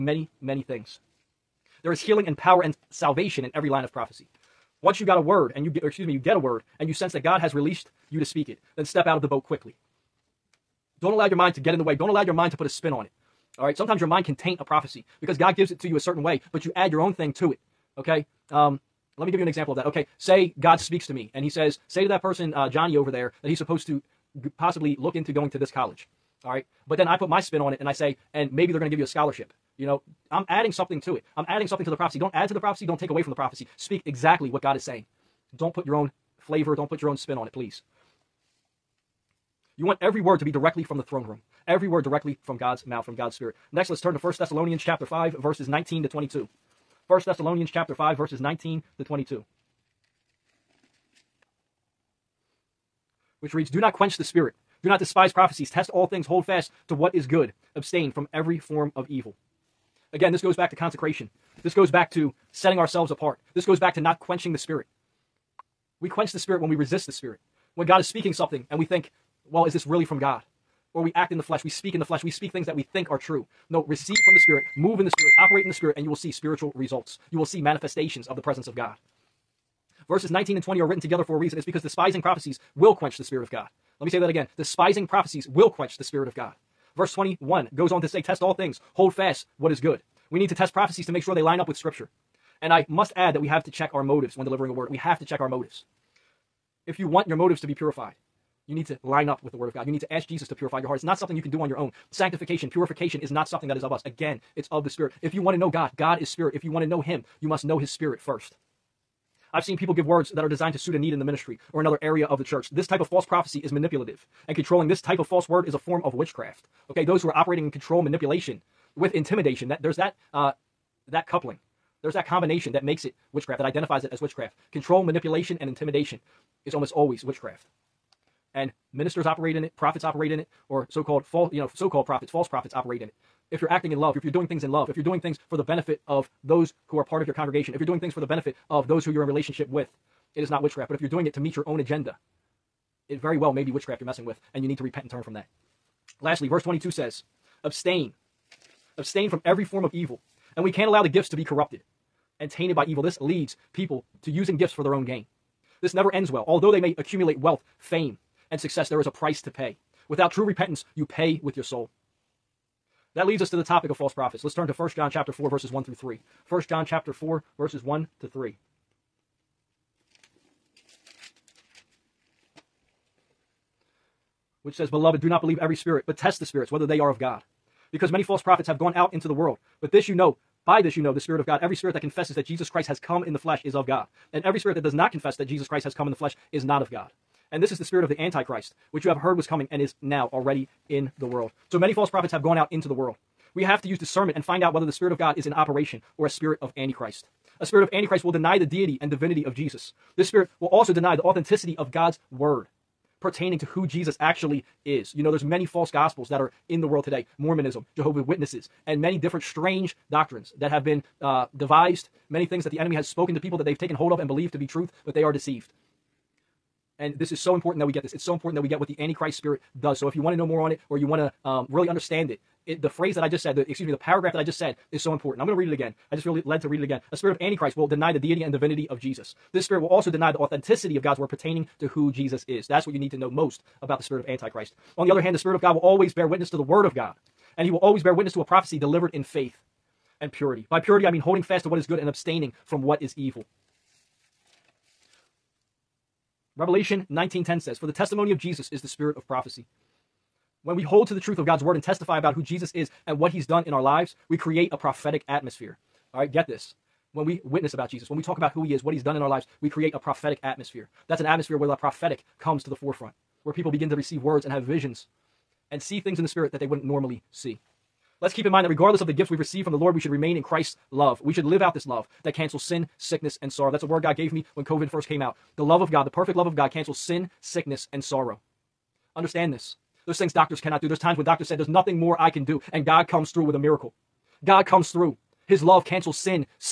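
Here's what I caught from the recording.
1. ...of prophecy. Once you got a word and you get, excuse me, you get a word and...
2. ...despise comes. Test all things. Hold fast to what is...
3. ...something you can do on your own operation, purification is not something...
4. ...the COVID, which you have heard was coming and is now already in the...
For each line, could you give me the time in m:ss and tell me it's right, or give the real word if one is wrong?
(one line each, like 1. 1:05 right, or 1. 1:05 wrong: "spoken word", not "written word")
1. 0:03 right
2. 0:54 wrong: "prophecies", not "comes"
3. 1:41 wrong: "sanctification", not "operation"
4. 3:08 wrong: "Antichrist", not "COVID".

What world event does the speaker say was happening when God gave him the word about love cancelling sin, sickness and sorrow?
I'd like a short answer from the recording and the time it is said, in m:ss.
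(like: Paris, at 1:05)
COVID, at 4:34.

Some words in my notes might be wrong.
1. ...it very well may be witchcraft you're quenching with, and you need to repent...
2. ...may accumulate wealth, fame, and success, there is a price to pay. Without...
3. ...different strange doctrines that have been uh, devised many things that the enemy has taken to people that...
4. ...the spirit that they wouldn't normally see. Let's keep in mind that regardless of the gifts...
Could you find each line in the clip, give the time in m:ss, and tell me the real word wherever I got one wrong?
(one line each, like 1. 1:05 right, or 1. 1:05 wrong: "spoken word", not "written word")
1. 2:23 wrong: "messing", not "quenching"
2. 2:36 right
3. 3:29 wrong: "spoken", not "taken"
4. 4:26 right.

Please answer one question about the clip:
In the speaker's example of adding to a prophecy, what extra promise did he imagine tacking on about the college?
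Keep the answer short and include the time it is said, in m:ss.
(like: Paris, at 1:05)
a scholarship, at 0:28.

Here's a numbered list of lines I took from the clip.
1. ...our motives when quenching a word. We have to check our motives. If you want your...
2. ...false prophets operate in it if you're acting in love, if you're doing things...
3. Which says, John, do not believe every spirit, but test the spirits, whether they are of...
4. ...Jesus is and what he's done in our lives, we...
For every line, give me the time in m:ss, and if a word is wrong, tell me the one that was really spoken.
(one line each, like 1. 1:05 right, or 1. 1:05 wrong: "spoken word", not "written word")
1. 1:33 wrong: "delivering", not "quenching"
2. 2:12 right
3. 2:54 wrong: "Beloved", not "John"
4. 4:12 right.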